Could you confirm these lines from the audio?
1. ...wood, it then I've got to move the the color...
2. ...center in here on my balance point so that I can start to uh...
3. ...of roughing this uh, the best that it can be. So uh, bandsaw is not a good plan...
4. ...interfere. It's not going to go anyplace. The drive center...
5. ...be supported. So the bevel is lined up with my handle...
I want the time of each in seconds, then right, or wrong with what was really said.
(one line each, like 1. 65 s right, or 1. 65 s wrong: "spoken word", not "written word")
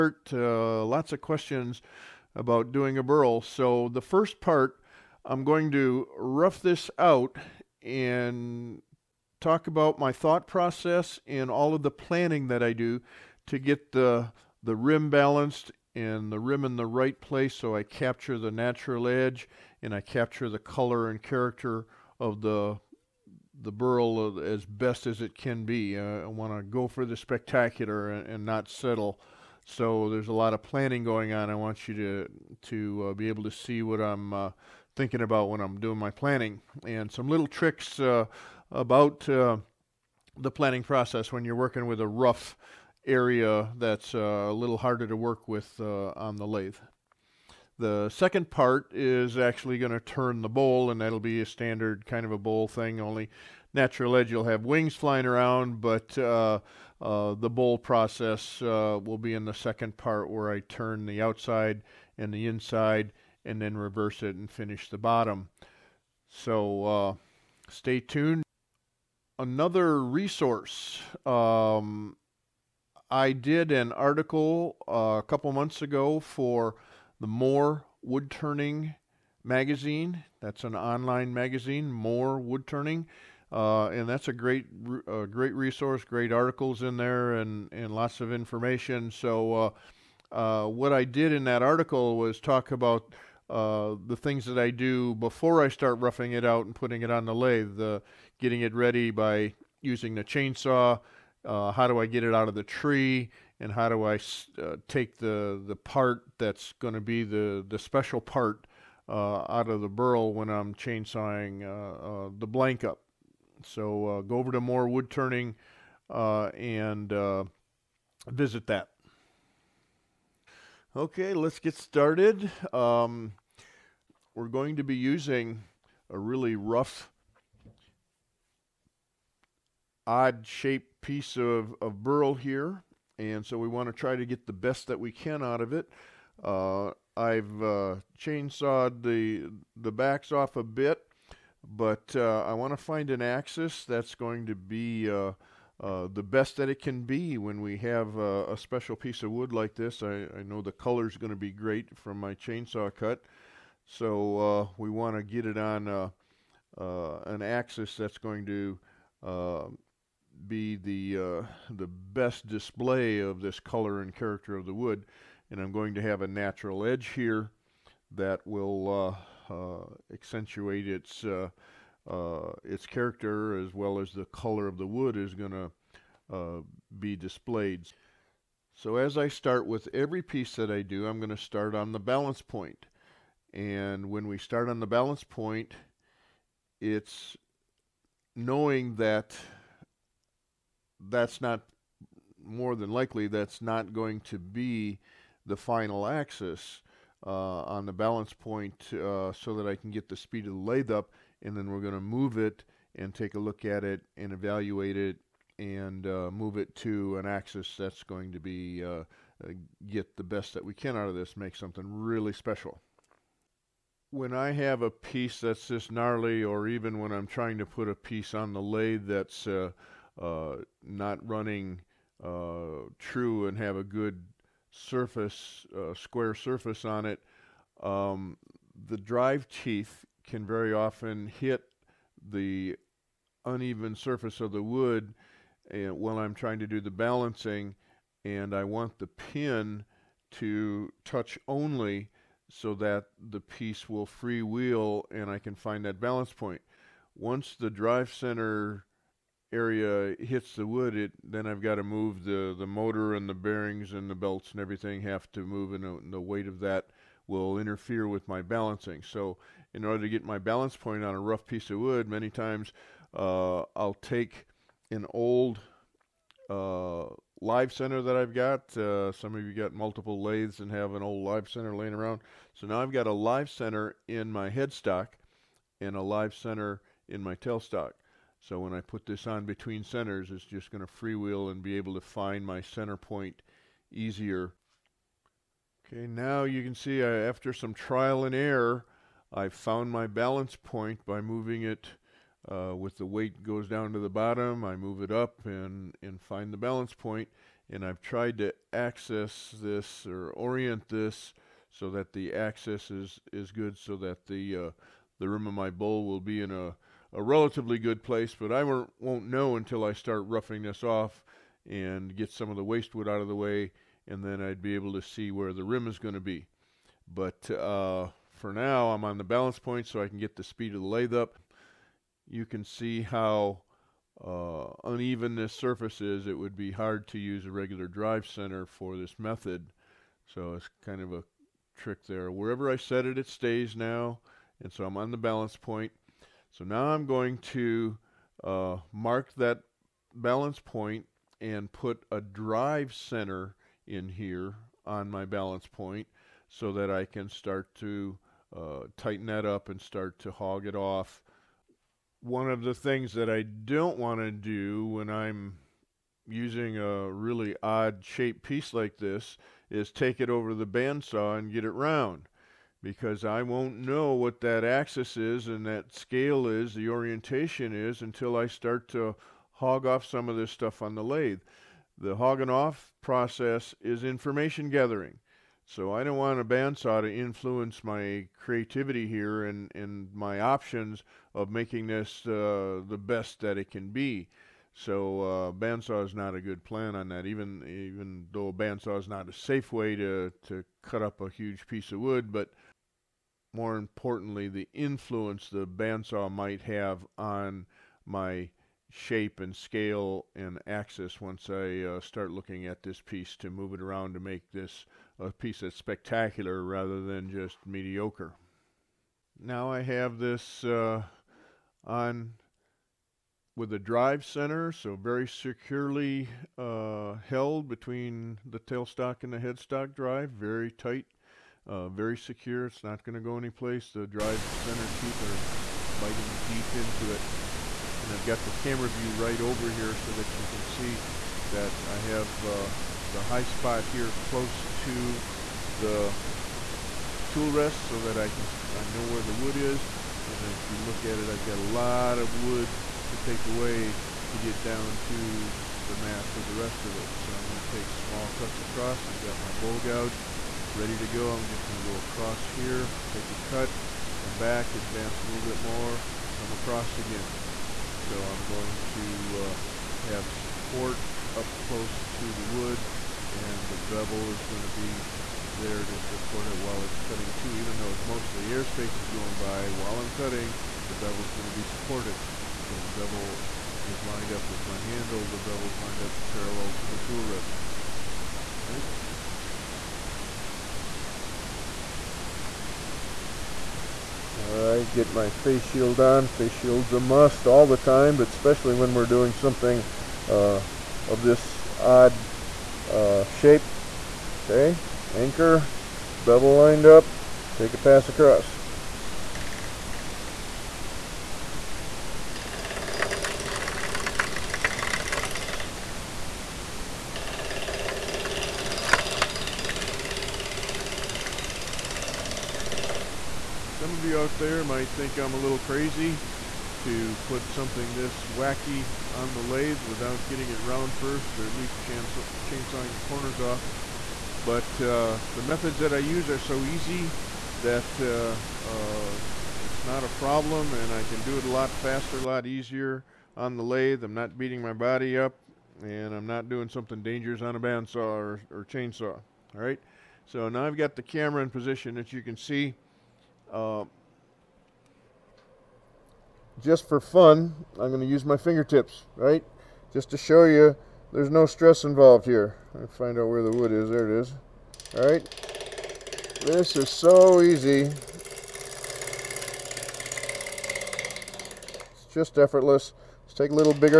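1. 250 s wrong: "motor", not "color"
2. 342 s right
3. 381 s wrong: "making", not "roughing"
4. 422 s wrong: "secure", not "interfere"
5. 471 s right.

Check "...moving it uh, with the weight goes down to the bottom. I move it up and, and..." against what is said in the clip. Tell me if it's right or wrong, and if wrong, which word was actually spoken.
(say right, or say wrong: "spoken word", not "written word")
right.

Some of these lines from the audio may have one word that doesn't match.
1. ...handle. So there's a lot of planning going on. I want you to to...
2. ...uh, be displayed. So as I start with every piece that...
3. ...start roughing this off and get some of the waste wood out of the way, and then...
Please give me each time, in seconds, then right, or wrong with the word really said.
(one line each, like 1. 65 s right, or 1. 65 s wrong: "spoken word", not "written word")
1. 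28 s wrong: "settle", not "handle"
2. 176 s right
3. 309 s right.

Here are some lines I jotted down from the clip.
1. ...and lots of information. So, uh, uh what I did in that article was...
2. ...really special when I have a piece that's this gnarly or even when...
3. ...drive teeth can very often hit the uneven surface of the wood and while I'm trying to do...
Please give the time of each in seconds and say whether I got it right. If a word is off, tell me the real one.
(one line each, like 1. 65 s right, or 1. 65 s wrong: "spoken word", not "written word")
1. 87 s right
2. 211 s right
3. 228 s right.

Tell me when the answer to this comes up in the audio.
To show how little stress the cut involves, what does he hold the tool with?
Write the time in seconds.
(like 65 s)
548 s.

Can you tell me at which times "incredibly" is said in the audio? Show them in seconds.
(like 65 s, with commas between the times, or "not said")
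not said.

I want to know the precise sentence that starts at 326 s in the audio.
It would be hard to use a regular drive center for this method, so it's kind of a trick there.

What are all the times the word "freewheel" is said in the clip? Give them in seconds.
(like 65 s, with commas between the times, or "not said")
244 s, 280 s.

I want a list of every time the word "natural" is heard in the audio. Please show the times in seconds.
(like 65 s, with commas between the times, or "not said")
18 s, 53 s, 166 s.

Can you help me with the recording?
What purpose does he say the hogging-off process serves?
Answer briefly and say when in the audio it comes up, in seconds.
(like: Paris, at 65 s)
Information gathering, at 374 s.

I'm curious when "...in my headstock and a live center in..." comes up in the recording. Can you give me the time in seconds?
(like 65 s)
274 s.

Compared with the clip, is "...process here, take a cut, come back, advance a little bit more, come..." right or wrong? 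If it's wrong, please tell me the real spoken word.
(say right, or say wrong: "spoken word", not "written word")
wrong: "across", not "process".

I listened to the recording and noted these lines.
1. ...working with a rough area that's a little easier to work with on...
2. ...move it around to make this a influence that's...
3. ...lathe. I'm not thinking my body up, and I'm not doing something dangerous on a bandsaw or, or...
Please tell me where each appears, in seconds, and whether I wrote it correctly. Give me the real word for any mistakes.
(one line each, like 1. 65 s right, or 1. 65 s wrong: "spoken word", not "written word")
1. 41 s wrong: "harder", not "easier"
2. 403 s wrong: "piece", not "influence"
3. 533 s wrong: "beating", not "thinking".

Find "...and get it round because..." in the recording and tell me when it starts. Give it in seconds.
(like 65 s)
361 s.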